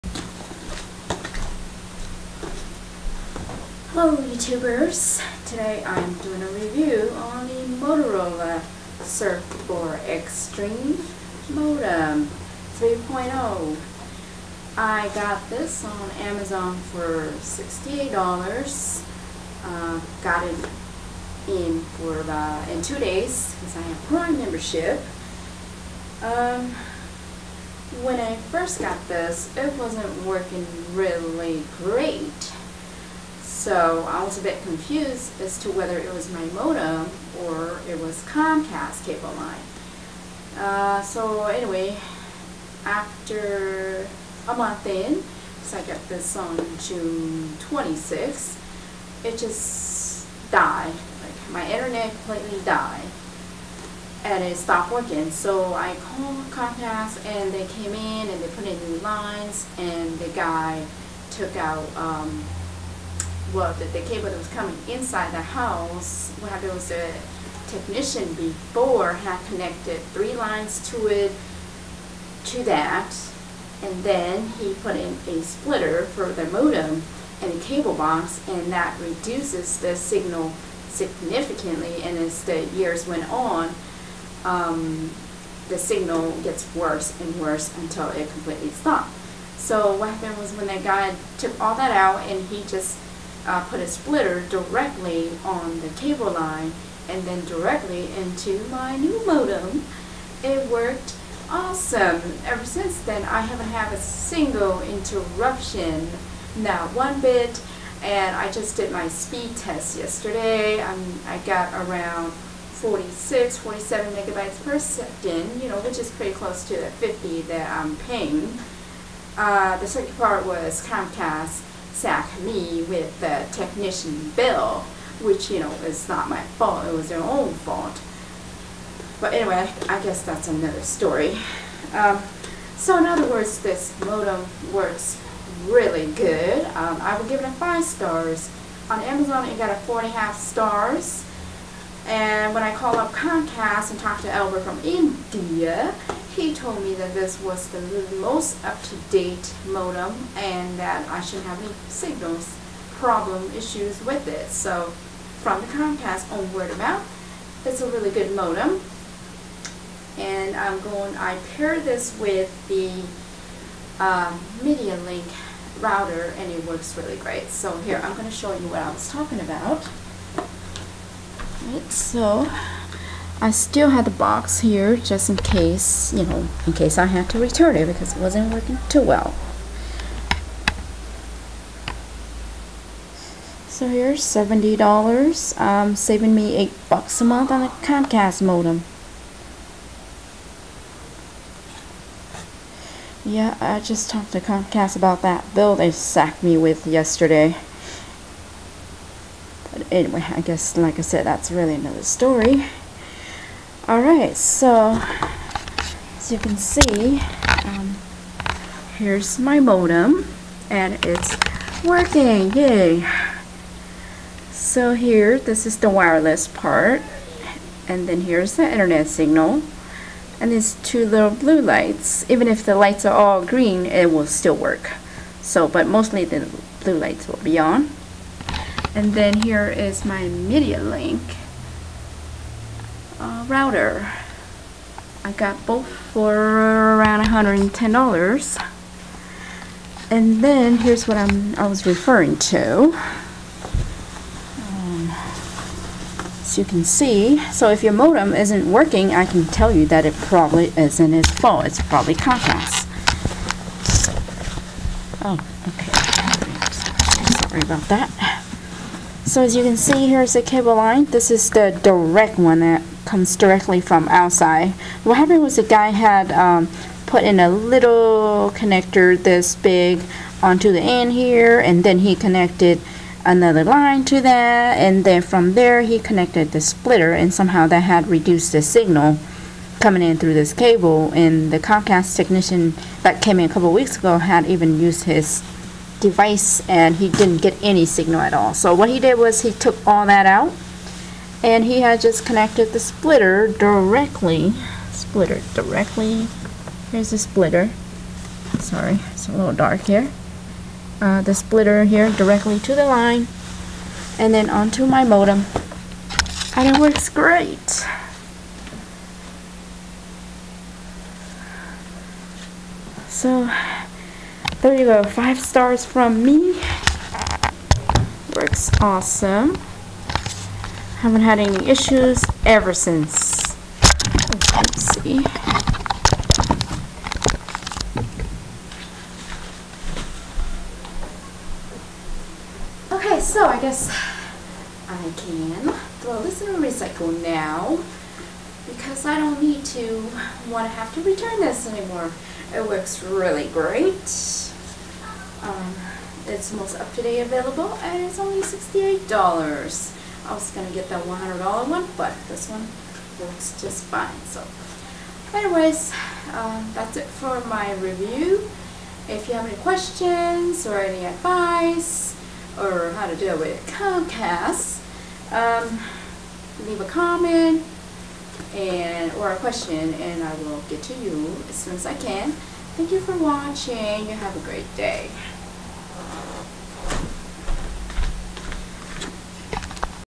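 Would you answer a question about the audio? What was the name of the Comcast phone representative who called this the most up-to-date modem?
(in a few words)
Albert.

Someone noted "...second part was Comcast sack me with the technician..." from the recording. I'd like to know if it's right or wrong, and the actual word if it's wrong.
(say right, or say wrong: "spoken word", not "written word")
right.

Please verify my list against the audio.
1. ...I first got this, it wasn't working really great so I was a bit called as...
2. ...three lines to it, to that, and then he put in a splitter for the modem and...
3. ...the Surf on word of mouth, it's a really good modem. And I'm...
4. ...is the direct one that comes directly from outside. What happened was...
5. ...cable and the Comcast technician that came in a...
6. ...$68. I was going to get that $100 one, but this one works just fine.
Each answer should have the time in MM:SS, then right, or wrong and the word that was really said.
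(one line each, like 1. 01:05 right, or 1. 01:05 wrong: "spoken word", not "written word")
1. 00:28 wrong: "confused", not "called"
2. 01:10 right
3. 02:35 wrong: "Comcast", not "Surf"
4. 04:21 right
5. 04:40 right
6. 05:48 right.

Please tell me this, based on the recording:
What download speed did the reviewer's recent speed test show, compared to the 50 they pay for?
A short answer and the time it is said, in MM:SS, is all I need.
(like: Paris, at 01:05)
46, 47, at 01:52.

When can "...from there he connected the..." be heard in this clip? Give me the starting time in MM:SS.
04:35.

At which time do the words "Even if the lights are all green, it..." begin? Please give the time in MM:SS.
03:42.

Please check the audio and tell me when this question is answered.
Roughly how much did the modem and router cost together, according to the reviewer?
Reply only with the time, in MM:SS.
03:57.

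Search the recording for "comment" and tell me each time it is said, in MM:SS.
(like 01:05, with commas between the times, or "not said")
06:06.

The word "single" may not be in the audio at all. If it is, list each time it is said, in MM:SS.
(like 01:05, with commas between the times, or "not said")
01:43.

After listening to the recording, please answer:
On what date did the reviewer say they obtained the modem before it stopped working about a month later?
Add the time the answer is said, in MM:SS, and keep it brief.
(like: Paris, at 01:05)
June 26th, at 00:46.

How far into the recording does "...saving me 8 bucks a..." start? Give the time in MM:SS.
03:05.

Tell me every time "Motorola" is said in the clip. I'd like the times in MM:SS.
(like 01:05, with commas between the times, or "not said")
00:07.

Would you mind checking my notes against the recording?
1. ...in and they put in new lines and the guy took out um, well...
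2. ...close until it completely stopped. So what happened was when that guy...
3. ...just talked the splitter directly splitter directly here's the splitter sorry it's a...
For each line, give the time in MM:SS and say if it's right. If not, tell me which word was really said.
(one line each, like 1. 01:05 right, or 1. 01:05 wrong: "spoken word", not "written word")
1. 00:57 right
2. 01:27 wrong: "worse", not "close"
3. 04:51 wrong: "connected", not "talked".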